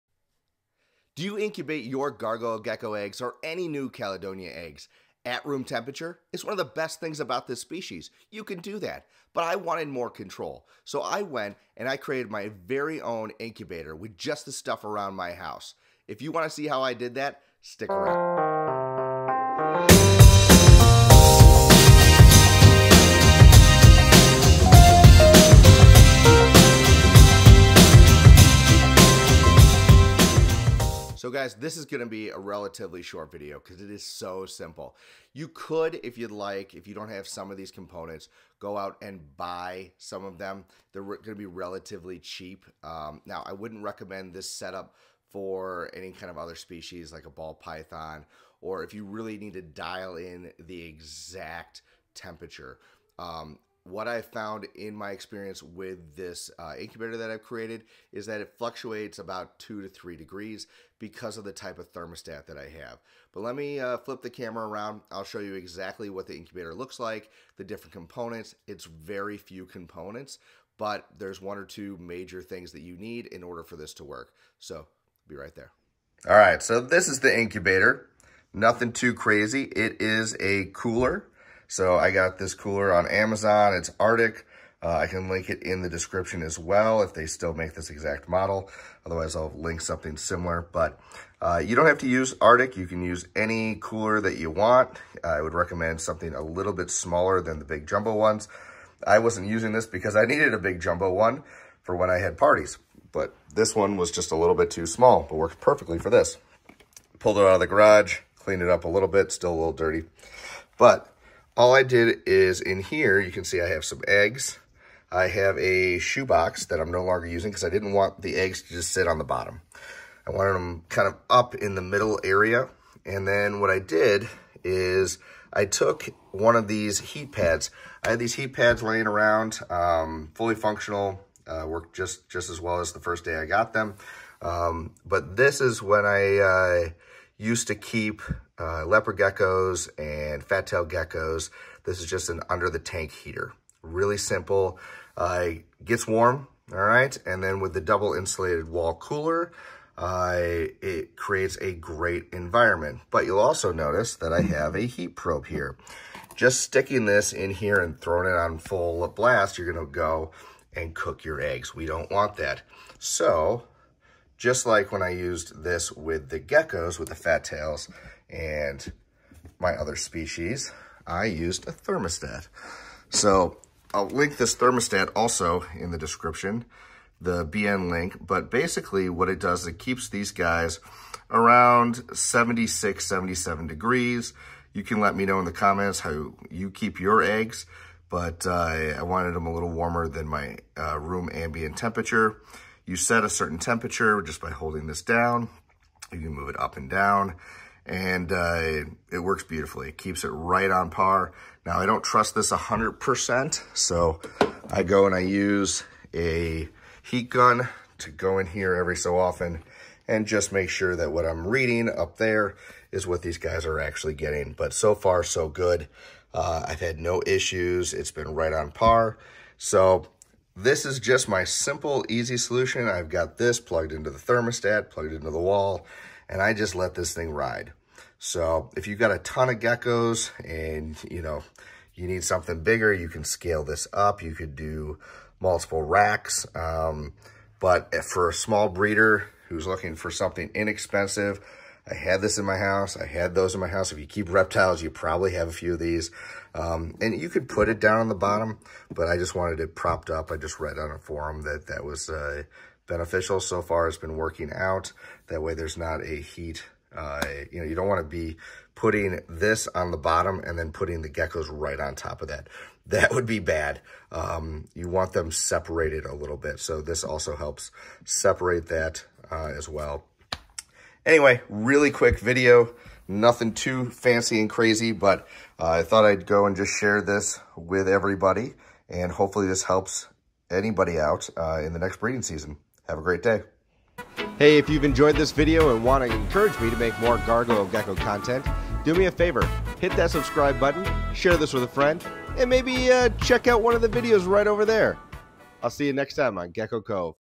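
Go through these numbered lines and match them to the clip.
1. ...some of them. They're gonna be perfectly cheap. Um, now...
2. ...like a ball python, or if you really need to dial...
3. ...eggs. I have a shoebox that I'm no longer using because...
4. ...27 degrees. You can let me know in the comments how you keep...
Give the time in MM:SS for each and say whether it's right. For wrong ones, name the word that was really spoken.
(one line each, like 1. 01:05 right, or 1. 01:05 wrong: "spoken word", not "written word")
1. 00:39 wrong: "relatively", not "perfectly"
2. 00:47 right
3. 01:54 right
4. 03:03 wrong: "77", not "27".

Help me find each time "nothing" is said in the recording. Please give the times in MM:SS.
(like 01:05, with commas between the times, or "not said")
01:18, 04:33.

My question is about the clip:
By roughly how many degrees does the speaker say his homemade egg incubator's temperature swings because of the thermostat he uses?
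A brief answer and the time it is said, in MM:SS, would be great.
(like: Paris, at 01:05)
2 to 3 degrees, at 00:59.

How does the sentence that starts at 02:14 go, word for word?
Um, but this is when I uh, used to keep uh, leopard geckos and fat tail geckos.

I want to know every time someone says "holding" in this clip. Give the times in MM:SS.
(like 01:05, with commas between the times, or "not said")
03:14.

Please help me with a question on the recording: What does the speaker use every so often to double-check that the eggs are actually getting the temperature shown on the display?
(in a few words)
A heat gun.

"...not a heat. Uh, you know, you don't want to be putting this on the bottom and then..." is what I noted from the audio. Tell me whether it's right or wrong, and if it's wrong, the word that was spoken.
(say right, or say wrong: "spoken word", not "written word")
right.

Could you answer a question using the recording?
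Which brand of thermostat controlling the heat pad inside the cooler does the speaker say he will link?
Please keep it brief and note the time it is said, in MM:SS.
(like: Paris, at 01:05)
BN-LINK, at 02:57.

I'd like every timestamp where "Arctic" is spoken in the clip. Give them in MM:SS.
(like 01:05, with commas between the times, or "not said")
01:23, 01:32.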